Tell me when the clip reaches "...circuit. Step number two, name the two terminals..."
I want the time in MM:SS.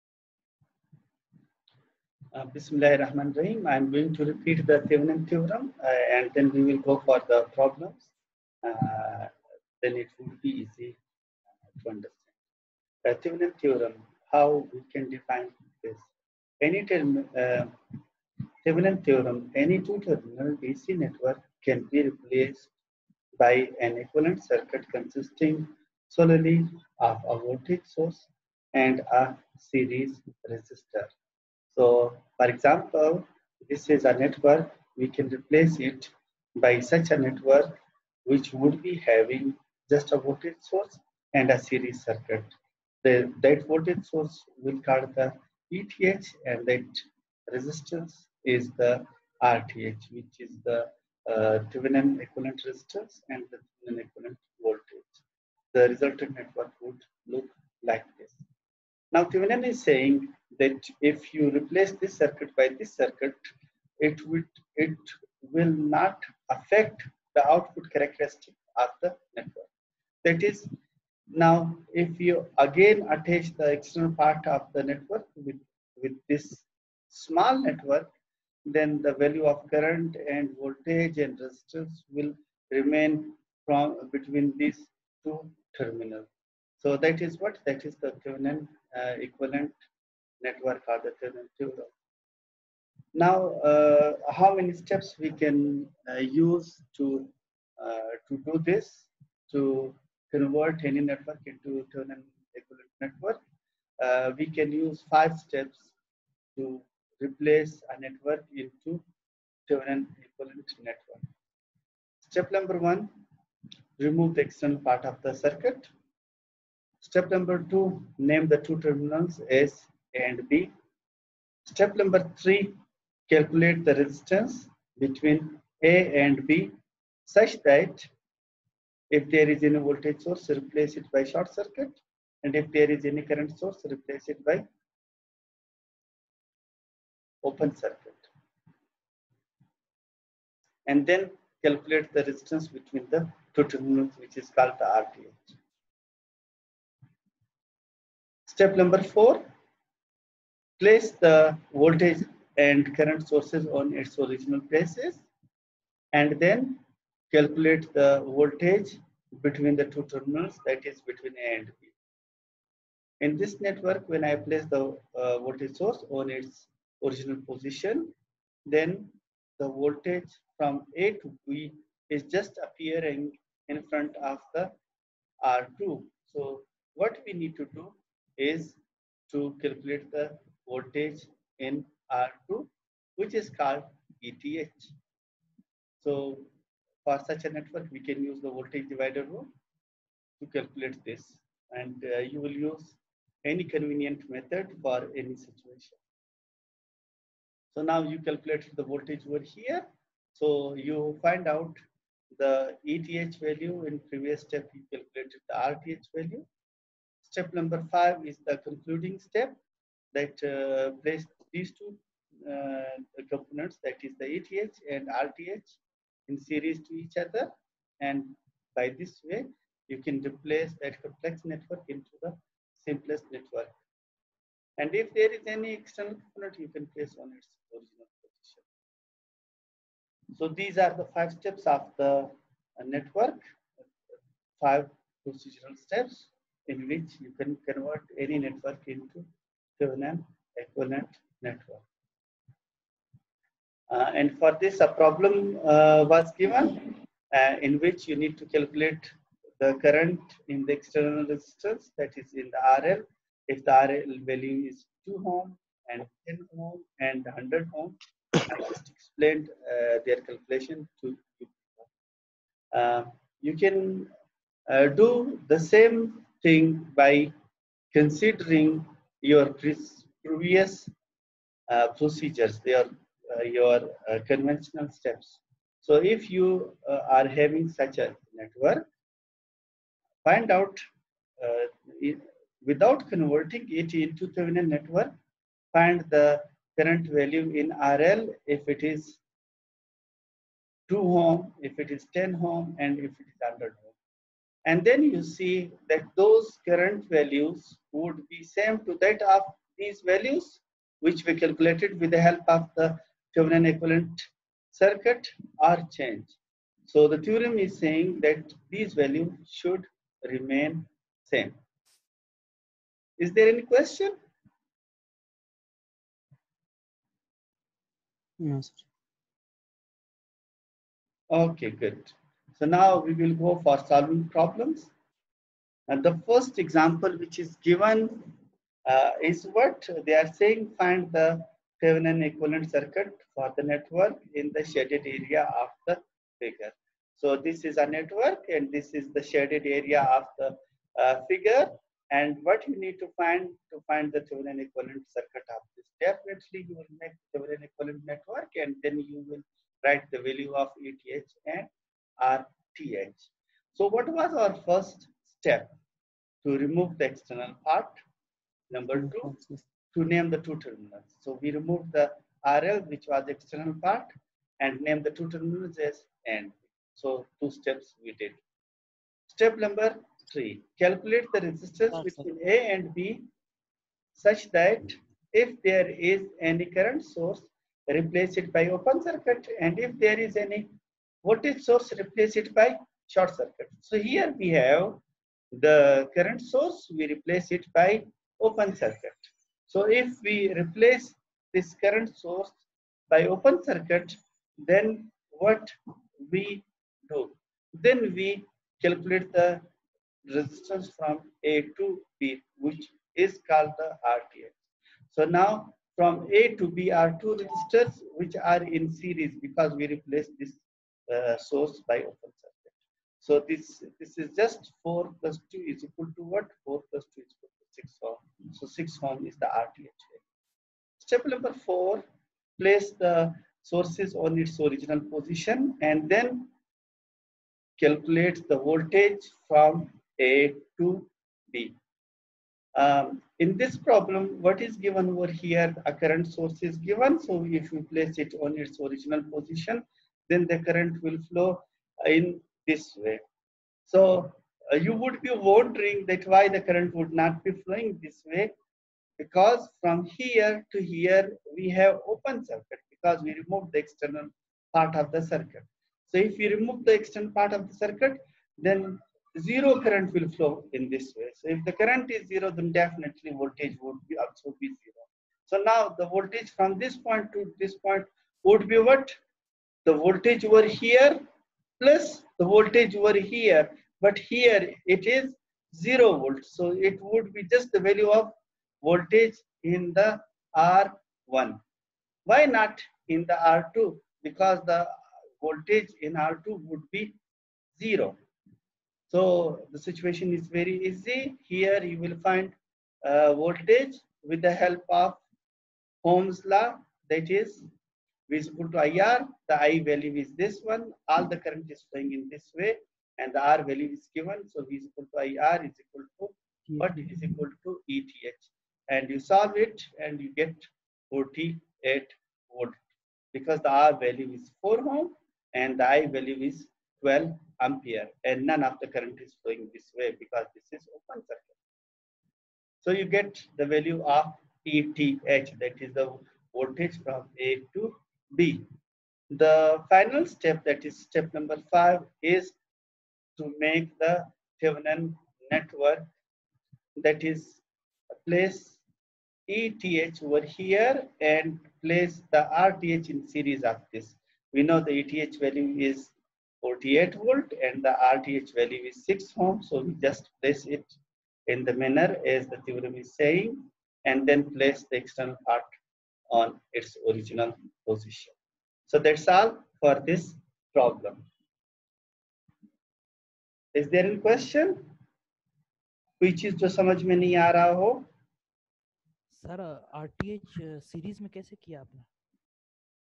01:55.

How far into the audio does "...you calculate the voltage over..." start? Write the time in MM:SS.
03:18.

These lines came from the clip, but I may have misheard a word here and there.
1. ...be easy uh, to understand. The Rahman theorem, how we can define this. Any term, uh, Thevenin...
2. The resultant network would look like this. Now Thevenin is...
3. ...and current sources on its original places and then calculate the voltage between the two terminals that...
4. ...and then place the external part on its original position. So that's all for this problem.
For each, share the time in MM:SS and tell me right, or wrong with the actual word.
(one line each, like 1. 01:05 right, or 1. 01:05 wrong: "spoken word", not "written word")
1. 00:10 wrong: "Thevenin", not "Rahman"
2. 00:55 right
3. 02:32 right
4. 09:14 right.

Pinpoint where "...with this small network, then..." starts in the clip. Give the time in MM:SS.
01:16.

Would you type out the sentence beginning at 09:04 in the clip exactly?
We know the ETH value is 48 volt and the RTH value is 6 ohm.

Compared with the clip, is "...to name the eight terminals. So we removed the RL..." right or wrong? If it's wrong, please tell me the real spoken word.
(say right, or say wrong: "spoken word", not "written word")
wrong: "two", not "eight".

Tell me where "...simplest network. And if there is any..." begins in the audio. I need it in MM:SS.
03:42.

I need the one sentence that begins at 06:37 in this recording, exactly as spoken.
Then we calculate the resistance from A to B, which is called the RTH.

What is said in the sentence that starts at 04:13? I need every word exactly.
If the RL value is 2 ohm and 10 ohm and 100 ohm, I just explained uh, their calculation to you.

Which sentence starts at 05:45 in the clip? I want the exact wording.
Definitely you will make Thevenin equivalent network and then you will write the value of ETH and RTH.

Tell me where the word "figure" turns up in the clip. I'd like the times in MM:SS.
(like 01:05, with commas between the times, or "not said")
05:36, 05:41.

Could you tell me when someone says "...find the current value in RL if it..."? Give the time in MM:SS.
04:45.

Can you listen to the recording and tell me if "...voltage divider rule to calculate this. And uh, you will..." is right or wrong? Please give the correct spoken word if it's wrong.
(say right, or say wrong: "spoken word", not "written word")
right.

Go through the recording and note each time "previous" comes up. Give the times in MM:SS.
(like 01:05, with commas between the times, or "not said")
03:24, 04:30.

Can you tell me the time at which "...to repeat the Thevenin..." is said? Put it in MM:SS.
00:04.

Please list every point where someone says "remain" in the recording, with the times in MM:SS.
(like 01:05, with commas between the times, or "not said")
01:22, 05:10.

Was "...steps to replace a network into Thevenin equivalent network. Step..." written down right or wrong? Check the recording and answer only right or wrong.
right.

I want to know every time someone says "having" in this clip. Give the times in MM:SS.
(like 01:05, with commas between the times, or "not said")
00:38, 04:37.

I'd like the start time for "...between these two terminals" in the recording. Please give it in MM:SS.
01:24.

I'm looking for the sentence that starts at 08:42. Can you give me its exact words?
So you get the value of ETH that is the voltage from A to B.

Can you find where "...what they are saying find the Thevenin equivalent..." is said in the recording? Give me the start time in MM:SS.
05:29.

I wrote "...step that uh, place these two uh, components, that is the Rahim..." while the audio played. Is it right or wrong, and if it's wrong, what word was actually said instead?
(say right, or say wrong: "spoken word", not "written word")
wrong: "ETH", not "Rahim".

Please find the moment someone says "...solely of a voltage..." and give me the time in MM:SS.
00:26.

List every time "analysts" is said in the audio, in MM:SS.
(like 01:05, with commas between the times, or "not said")
not said.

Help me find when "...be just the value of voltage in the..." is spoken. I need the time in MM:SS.
07:57.